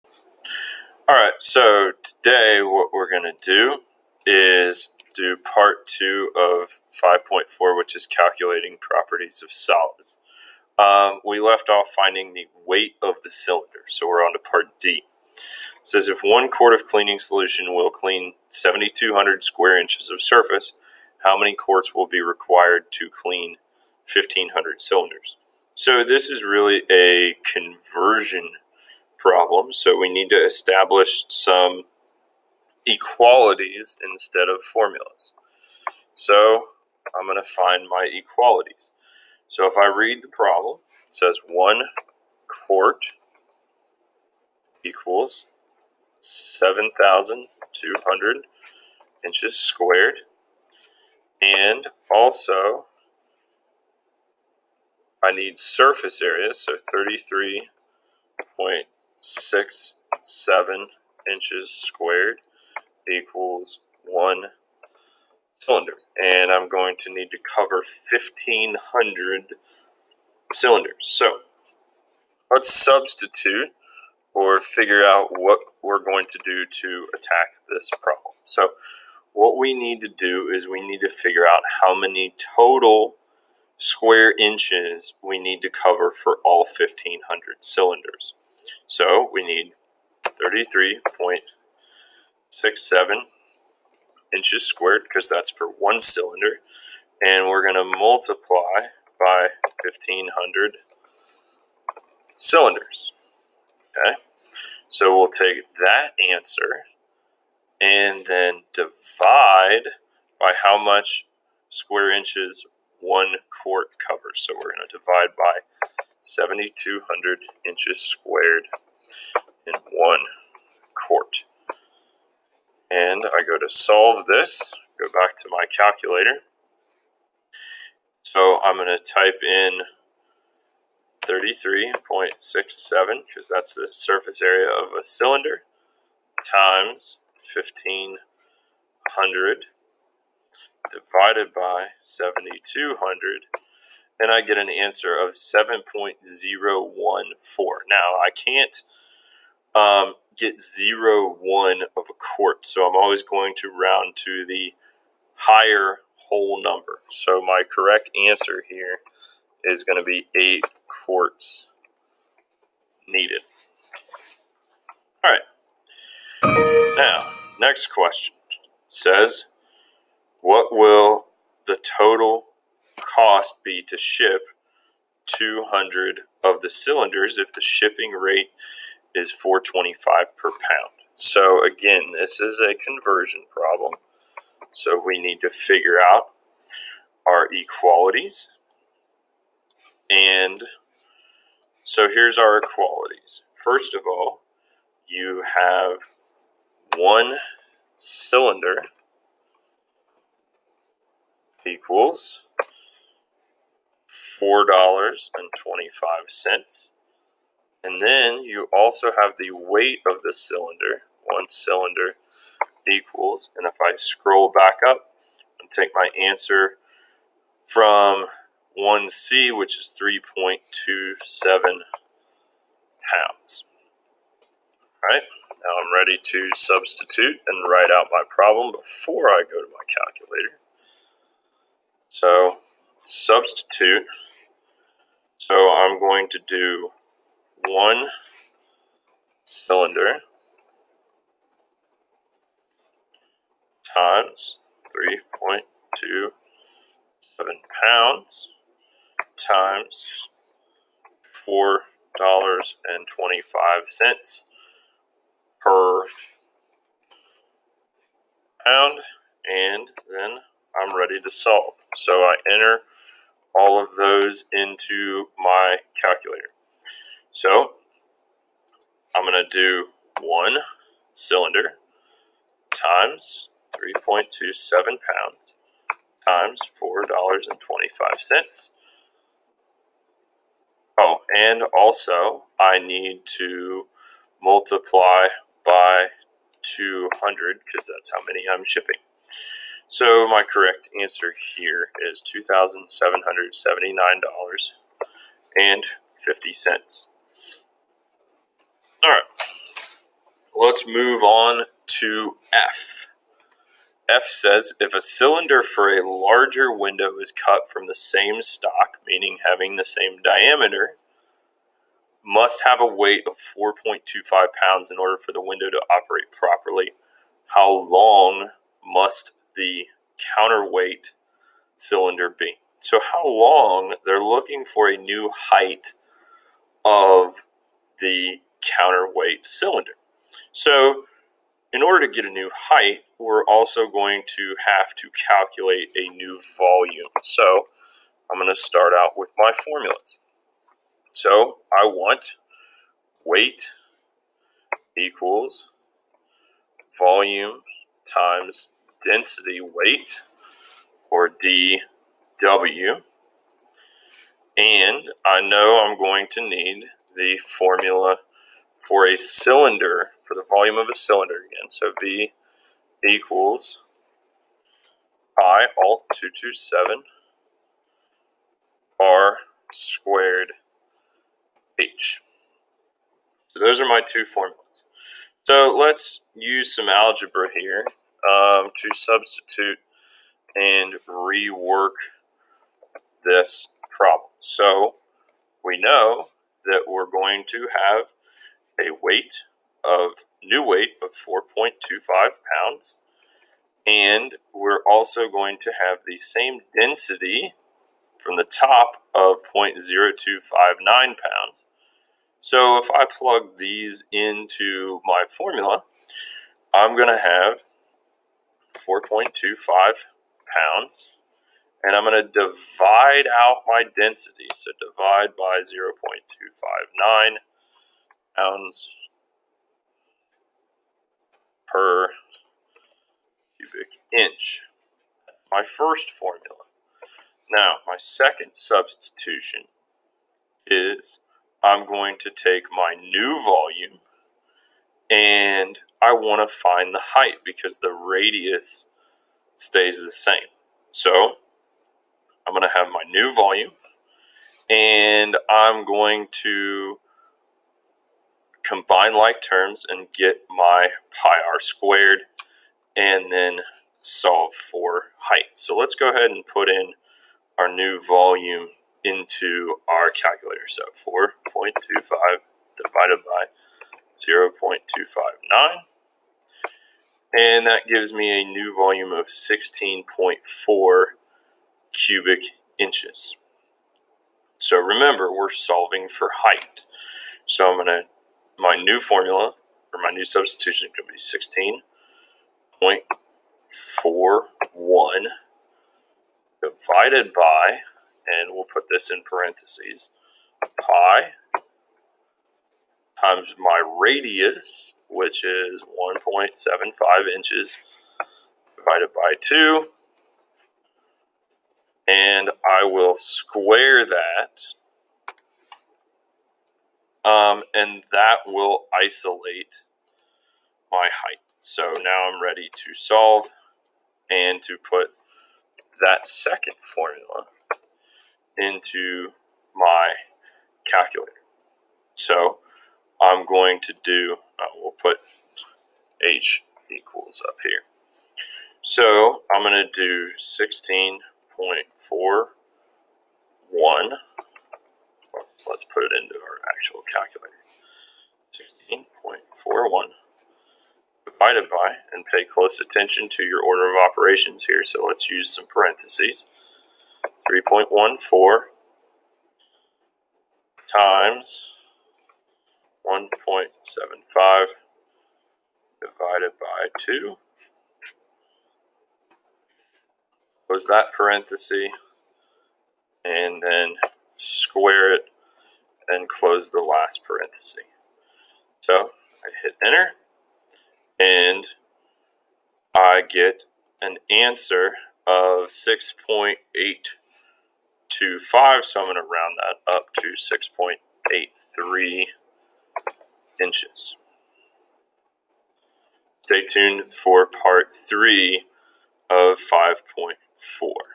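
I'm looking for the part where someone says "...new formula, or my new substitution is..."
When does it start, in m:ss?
7:58.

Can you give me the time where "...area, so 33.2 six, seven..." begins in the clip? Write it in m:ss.
0:56.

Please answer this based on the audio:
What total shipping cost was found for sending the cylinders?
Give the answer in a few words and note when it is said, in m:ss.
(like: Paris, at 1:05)
$2,779.50, at 4:52.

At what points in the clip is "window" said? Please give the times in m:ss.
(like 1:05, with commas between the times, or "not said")
5:06, 5:15.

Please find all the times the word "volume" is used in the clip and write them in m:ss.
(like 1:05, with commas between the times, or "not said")
5:36, 5:46, 6:00, 7:13, 7:23, 7:38, 7:48.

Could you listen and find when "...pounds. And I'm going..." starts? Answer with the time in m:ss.
6:50.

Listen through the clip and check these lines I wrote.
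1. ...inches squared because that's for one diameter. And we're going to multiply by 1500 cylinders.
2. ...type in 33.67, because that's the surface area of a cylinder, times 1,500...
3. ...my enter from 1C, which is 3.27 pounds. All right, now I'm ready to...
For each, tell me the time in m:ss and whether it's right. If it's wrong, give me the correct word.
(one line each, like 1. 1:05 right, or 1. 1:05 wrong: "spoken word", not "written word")
1. 1:34 wrong: "cylinder", not "diameter"
2. 2:09 right
3. 3:35 wrong: "answer", not "enter".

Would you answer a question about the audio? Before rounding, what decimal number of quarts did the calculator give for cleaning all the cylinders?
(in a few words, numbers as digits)
7.014.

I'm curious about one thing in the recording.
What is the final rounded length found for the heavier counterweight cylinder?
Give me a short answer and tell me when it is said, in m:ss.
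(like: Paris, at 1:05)
6.83 inches, at 9:40.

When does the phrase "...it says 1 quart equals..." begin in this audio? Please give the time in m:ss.
0:41.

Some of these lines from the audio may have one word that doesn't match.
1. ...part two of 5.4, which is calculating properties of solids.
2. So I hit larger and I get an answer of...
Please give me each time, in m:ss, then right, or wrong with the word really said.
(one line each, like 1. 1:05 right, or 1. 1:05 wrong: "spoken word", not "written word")
1. 0:05 right
2. 9:28 wrong: "enter", not "larger".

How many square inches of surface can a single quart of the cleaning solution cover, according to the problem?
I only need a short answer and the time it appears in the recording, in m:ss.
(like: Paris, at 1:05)
7,200, at 0:18.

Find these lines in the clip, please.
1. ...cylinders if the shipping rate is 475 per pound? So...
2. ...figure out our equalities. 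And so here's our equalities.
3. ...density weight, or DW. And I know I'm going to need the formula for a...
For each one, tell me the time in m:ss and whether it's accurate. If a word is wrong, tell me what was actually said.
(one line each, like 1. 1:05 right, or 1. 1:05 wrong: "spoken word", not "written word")
1. 2:56 wrong: "425", not "475"
2. 3:05 right
3. 5:49 right.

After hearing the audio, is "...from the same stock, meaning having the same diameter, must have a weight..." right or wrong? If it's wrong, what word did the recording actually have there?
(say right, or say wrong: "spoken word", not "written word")
right.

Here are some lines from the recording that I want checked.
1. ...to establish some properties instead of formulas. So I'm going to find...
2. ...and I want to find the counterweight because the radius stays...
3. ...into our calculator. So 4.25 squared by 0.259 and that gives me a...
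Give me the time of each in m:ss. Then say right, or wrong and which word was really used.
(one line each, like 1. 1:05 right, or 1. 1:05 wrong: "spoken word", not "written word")
1. 0:30 wrong: "equalities", not "properties"
2. 7:15 wrong: "height", not "counterweight"
3. 7:39 wrong: "divided", not "squared".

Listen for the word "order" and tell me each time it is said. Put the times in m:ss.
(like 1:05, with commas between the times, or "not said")
5:14, 5:31, 9:03.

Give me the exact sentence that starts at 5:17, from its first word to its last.
How long must the counterweight cylinder B.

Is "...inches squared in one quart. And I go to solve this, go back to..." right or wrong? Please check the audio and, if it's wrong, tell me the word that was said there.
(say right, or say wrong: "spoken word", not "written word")
right.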